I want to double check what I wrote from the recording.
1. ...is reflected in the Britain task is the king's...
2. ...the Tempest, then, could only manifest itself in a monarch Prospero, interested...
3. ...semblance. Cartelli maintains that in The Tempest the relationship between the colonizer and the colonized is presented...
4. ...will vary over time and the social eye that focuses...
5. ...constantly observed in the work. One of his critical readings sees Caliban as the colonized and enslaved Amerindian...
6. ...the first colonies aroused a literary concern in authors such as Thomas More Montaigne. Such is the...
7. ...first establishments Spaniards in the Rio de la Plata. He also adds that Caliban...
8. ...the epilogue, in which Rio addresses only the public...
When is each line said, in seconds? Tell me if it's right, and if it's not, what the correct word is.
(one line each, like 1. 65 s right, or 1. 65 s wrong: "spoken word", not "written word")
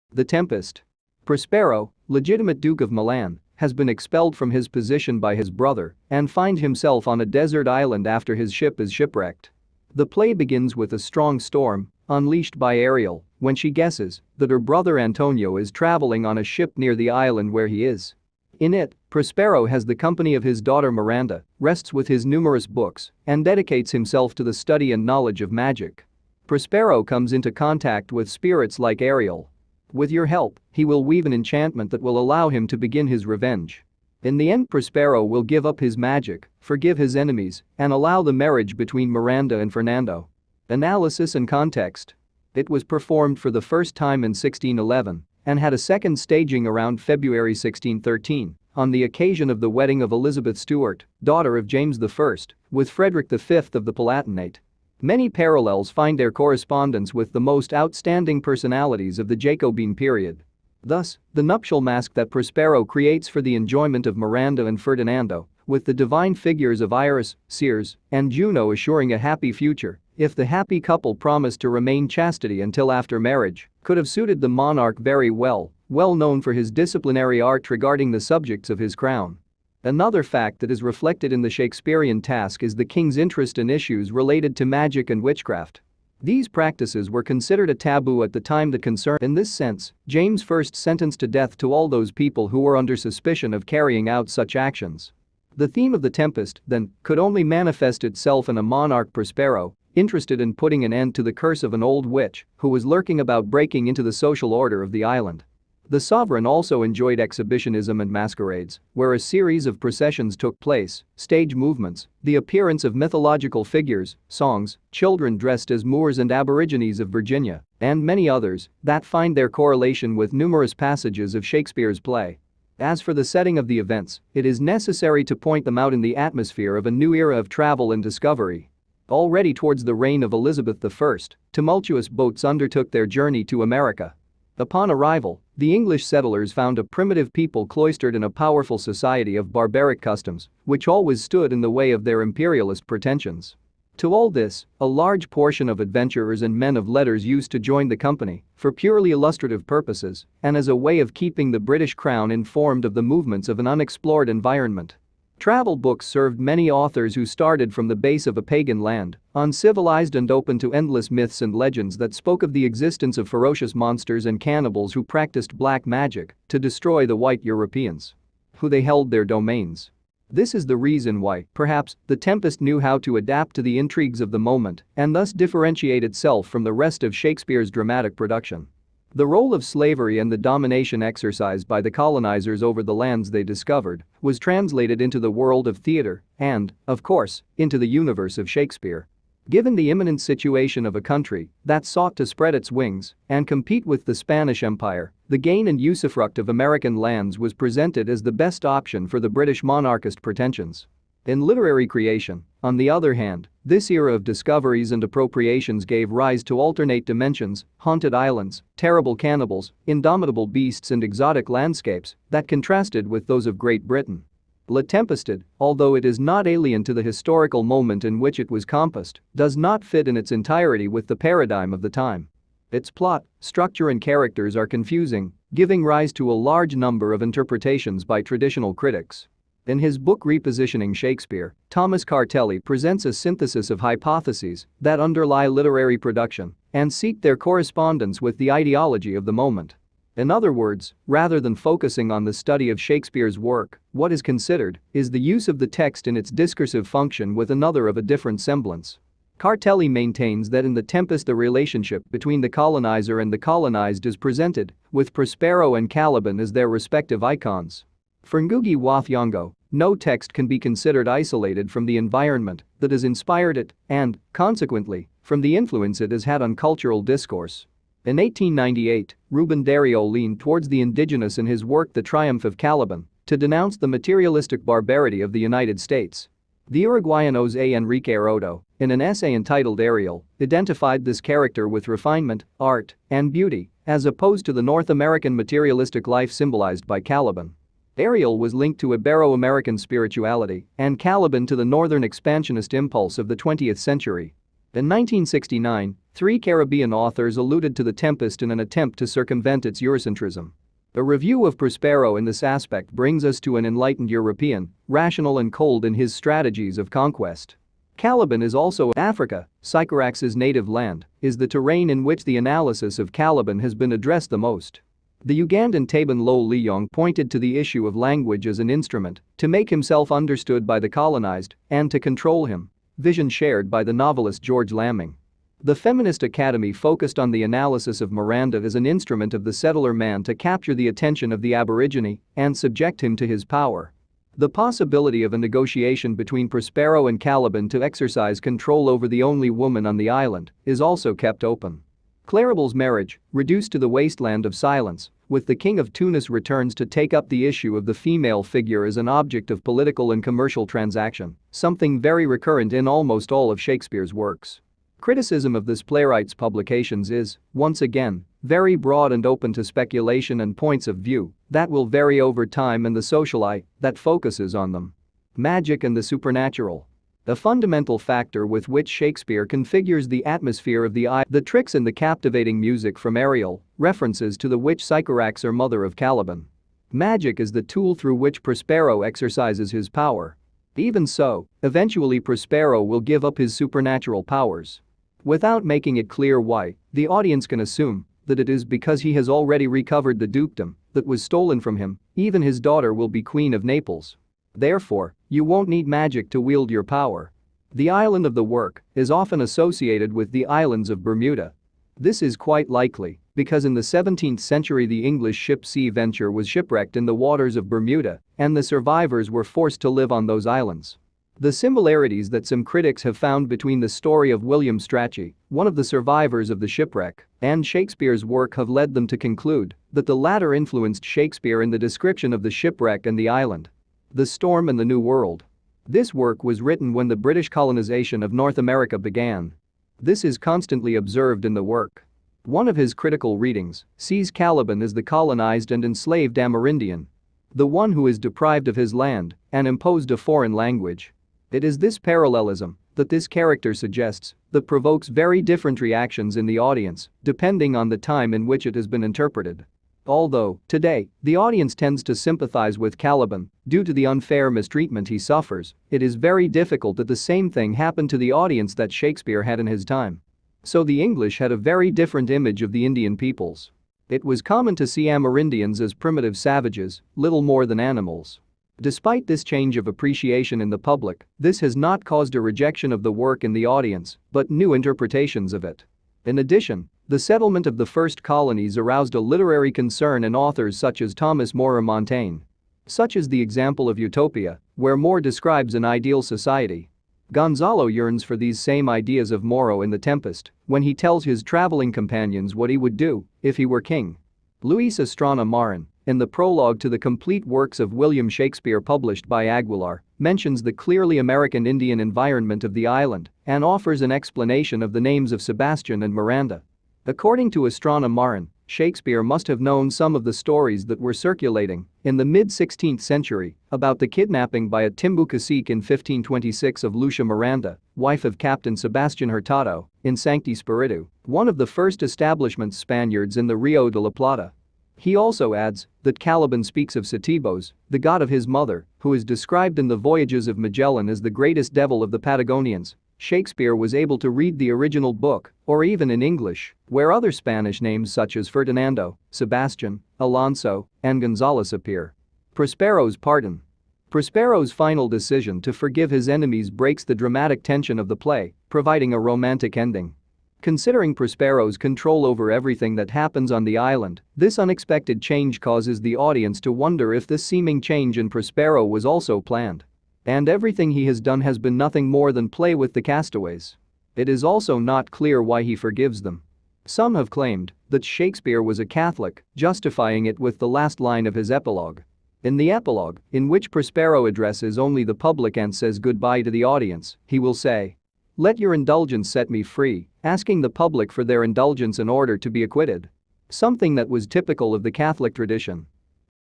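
1. 80 s wrong: "Shakespearean", not "Britain"
2. 96 s right
3. 248 s right
4. 361 s right
5. 430 s right
6. 477 s right
7. 521 s right
8. 572 s wrong: "Prospero", not "Rio".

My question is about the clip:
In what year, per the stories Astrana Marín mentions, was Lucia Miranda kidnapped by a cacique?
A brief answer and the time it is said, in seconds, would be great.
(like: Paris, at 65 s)
1526, at 515 s.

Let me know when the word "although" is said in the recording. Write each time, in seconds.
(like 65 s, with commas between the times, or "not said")
215 s, 450 s.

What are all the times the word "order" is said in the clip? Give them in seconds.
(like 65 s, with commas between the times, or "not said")
104 s, 582 s.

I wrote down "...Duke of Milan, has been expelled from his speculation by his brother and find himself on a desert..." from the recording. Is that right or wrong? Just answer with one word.
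wrong.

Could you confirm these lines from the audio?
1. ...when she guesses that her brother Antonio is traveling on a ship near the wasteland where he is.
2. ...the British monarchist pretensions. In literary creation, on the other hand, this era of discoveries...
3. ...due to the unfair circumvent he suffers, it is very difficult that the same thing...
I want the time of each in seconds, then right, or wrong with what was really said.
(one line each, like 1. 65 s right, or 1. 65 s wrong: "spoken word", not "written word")
1. 13 s wrong: "island", not "wasteland"
2. 199 s right
3. 453 s wrong: "mistreatment", not "circumvent".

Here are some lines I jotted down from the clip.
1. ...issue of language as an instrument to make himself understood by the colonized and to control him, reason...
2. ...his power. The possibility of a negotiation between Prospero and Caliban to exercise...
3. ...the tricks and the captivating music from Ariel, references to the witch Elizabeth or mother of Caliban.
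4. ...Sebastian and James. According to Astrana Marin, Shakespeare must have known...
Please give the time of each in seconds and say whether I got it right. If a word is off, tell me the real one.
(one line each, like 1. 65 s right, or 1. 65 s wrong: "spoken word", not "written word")
1. 317 s wrong: "vision", not "reason"
2. 333 s right
3. 371 s wrong: "Sycorax", not "Elizabeth"
4. 505 s wrong: "Miranda", not "James".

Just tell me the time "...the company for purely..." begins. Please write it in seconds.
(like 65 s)
147 s.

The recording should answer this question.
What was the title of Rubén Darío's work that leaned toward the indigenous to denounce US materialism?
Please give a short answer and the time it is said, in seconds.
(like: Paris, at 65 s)
The Triumph of Caliban, at 271 s.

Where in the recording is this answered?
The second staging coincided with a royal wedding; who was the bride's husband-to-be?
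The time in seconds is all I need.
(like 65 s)
52 s.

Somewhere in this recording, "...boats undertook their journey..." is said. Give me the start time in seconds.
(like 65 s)
132 s.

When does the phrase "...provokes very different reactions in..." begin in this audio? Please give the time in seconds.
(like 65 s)
444 s.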